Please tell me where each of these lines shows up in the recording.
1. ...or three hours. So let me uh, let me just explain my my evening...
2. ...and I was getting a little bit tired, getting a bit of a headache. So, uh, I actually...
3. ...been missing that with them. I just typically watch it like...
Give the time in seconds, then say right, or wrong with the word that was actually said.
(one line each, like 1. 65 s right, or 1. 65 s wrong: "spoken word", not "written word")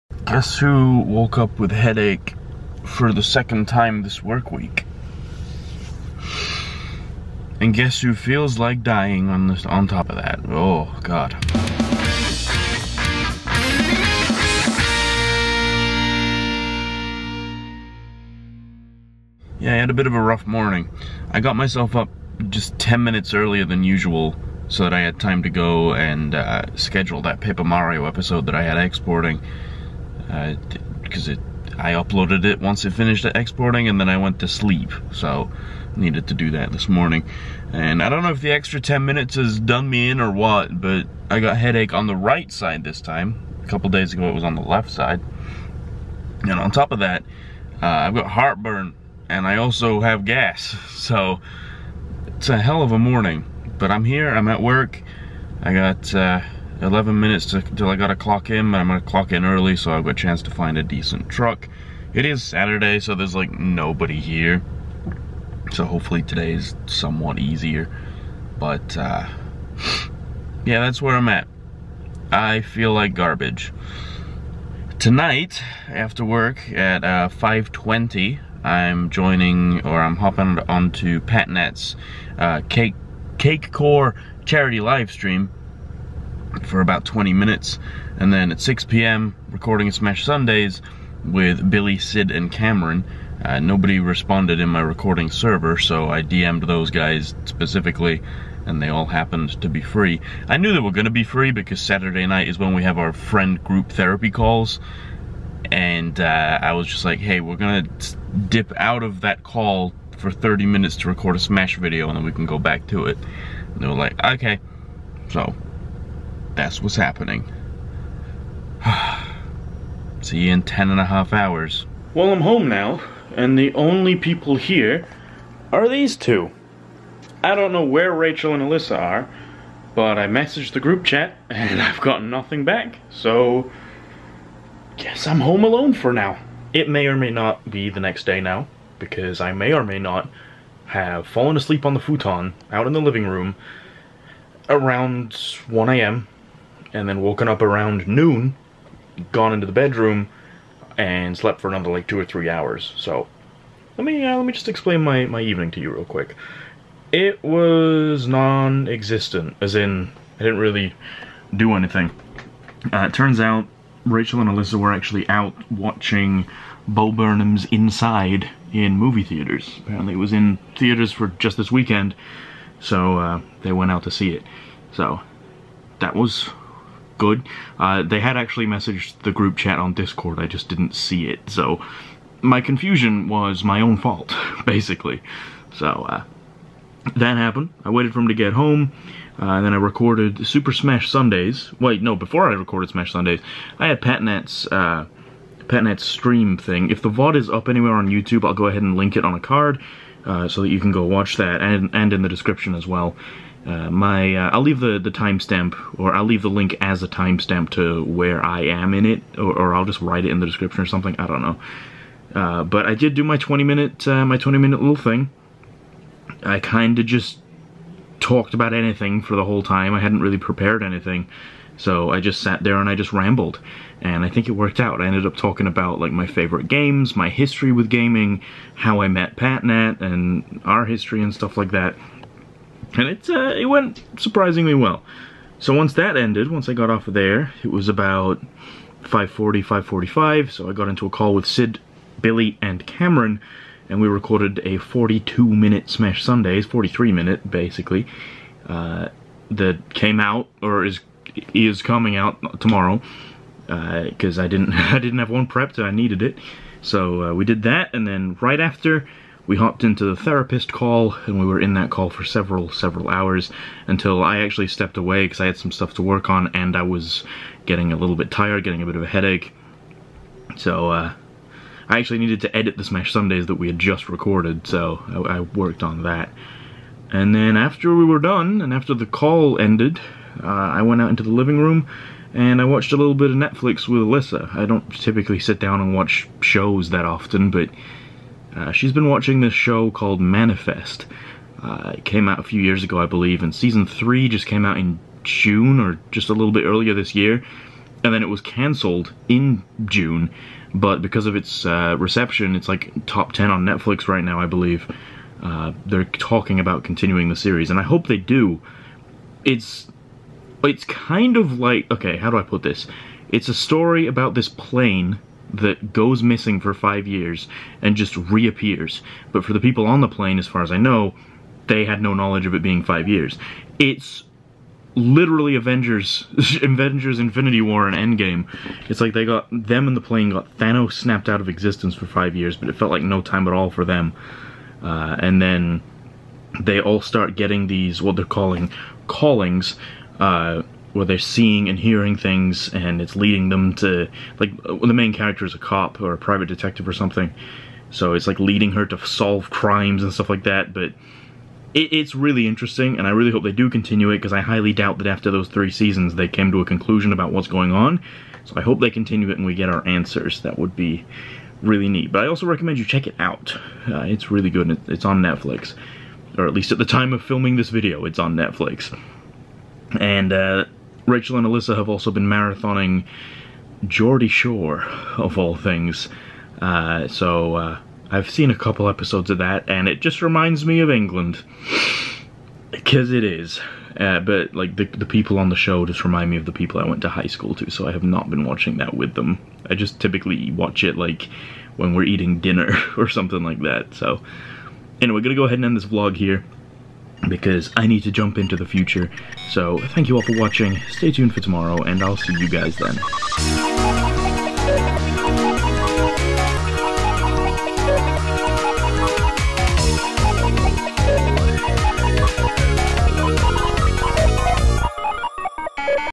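1. 152 s right
2. 266 s right
3. 388 s wrong: "watching", not "missing".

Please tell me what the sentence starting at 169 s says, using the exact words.
Apparently it was in theaters for just this weekend, so uh, they went out to see it.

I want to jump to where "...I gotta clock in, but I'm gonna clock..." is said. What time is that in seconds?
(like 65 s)
57 s.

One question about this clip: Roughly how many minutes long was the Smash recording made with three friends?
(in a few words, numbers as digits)
43.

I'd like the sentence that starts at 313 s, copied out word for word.
It's a story about this plane that goes missing for five years and just reappears.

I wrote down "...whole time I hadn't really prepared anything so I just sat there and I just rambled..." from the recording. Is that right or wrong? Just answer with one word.
right.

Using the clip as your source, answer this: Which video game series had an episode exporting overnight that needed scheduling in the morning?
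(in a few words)
Paper Mario.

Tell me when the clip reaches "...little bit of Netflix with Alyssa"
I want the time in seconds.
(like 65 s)
282 s.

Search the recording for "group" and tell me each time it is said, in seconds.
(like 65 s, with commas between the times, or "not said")
103 s, 130 s, 179 s.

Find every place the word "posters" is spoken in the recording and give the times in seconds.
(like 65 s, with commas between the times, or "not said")
not said.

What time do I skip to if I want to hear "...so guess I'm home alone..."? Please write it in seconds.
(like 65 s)
133 s.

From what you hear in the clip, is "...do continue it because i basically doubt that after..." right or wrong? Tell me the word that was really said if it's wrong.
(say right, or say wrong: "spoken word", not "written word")
wrong: "highly", not "basically".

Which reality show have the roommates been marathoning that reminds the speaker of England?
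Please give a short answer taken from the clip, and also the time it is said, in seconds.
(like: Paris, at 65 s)
Geordie Shore, at 373 s.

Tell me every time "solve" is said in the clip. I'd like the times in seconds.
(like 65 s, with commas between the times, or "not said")
349 s.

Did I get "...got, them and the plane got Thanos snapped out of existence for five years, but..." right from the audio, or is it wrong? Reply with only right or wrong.
right.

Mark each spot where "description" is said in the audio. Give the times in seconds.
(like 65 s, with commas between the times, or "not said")
202 s, 210 s.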